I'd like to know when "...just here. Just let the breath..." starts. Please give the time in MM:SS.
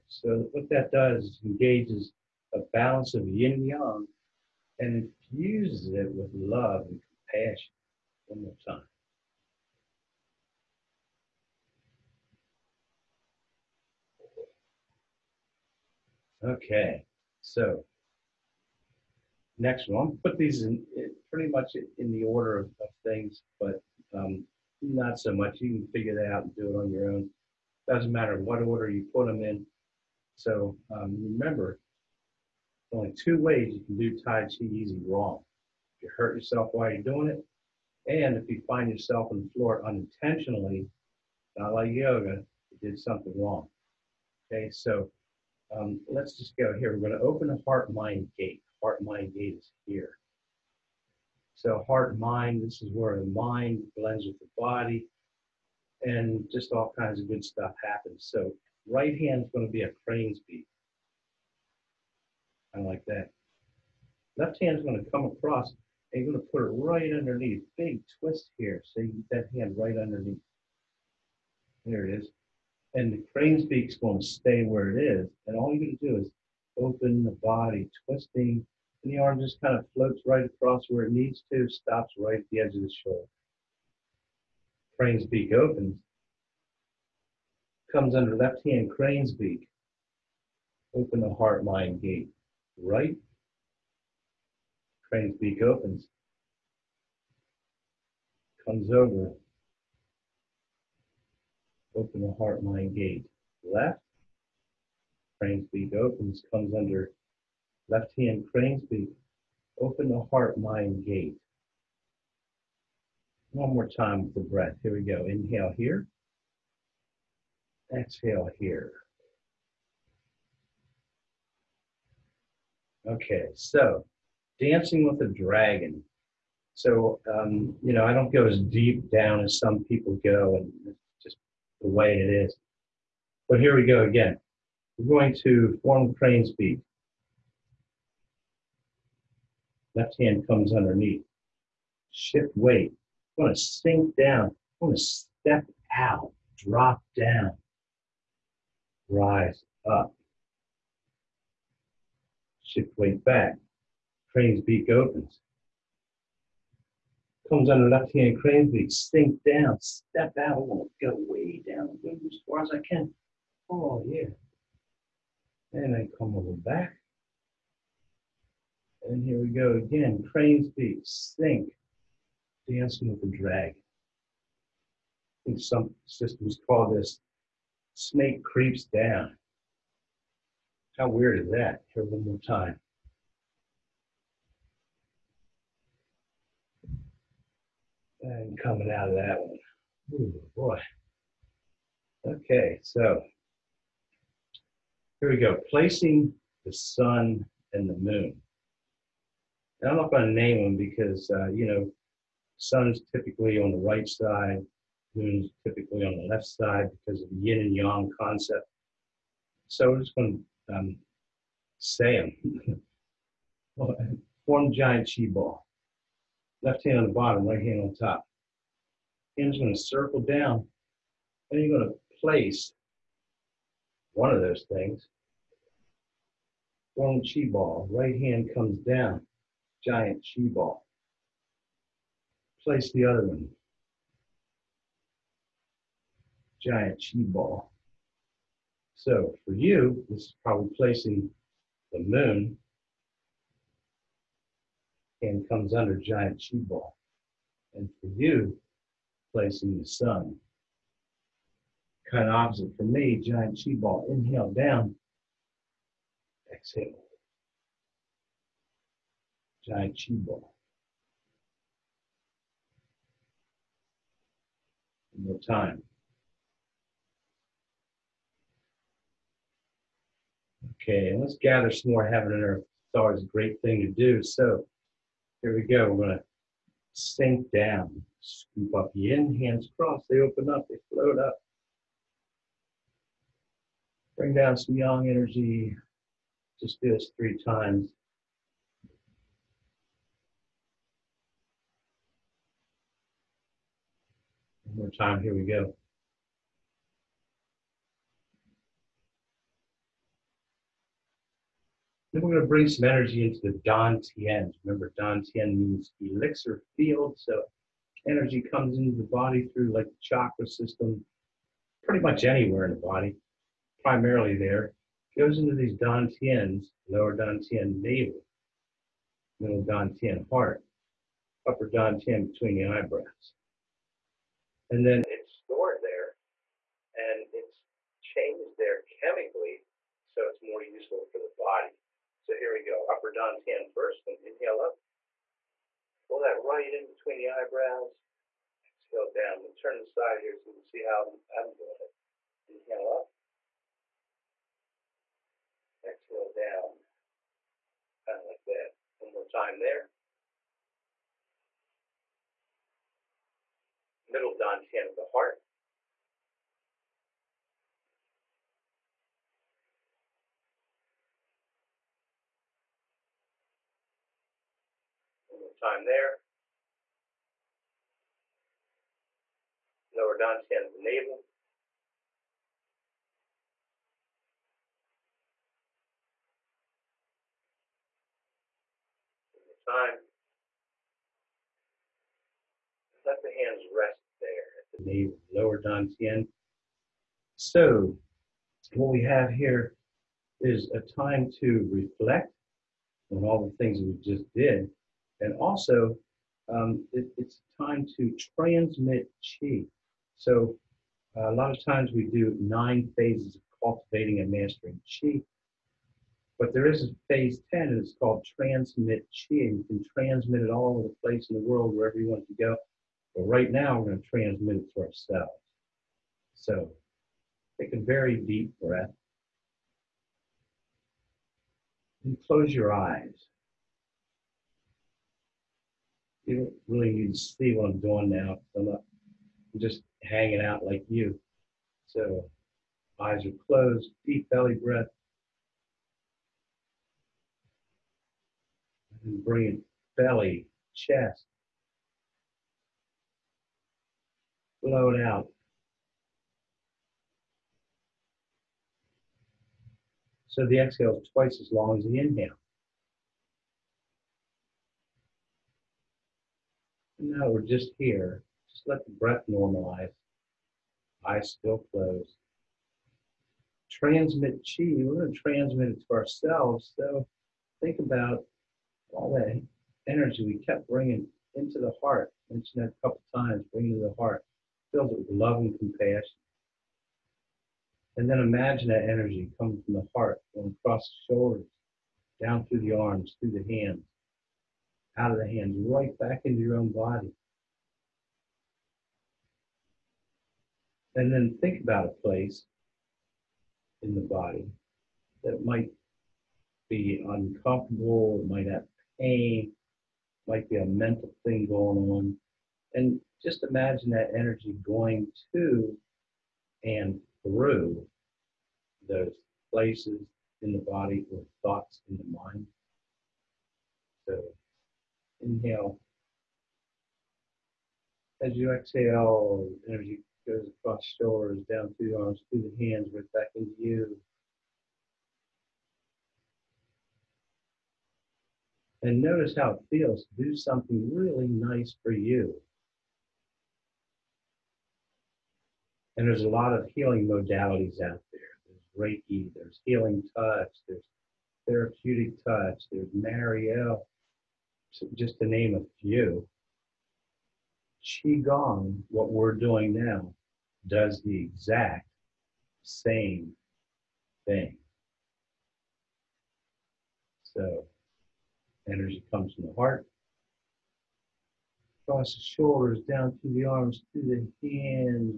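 07:37.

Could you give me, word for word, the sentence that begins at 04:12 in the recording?
Kind of opposite for me, giant chi ball.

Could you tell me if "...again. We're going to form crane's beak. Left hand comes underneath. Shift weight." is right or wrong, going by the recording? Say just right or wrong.
right.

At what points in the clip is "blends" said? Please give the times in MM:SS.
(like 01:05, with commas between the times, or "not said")
00:53.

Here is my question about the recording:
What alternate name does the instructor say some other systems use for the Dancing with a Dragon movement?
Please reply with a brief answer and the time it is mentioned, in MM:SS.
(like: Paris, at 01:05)
Snake creeps down, at 02:57.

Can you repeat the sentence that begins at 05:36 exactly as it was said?
Pull that right in between the eyebrows.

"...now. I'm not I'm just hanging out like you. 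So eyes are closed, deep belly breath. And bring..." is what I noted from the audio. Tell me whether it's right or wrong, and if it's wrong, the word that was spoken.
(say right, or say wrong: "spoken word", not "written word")
right.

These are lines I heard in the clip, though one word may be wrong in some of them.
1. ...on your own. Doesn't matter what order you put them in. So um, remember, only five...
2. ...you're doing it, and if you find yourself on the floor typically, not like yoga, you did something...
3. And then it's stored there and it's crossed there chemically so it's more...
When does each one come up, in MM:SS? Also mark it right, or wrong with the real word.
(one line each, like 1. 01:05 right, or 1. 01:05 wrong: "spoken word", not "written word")
1. 00:26 wrong: "two", not "five"
2. 00:36 wrong: "unintentionally", not "typically"
3. 05:24 wrong: "changed", not "crossed".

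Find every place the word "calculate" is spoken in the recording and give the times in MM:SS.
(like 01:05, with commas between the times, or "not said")
not said.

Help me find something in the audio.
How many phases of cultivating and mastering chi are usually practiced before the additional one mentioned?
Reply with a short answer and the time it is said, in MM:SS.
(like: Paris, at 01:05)
9, at 06:42.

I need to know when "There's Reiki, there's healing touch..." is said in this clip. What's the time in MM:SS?
08:58.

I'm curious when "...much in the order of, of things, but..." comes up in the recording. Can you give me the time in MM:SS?
00:21.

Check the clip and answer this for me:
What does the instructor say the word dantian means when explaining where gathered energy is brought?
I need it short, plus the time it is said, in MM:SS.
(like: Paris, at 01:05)
Elixir field, at 05:06.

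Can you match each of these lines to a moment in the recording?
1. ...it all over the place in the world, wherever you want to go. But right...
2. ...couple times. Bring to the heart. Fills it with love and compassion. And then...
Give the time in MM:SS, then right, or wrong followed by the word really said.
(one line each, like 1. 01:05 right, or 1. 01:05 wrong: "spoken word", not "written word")
1. 06:50 right
2. 07:52 right.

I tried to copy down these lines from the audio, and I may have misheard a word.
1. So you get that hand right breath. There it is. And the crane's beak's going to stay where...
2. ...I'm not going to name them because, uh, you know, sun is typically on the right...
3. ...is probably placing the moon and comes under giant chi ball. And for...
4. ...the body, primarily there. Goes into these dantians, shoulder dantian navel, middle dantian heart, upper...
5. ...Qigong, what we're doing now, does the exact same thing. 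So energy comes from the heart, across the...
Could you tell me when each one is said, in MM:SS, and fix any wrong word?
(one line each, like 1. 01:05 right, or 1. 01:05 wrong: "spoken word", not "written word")
1. 01:08 wrong: "underneath", not "breath"
2. 03:19 right
3. 04:00 right
4. 05:12 wrong: "lower", not "shoulder"
5. 09:07 right.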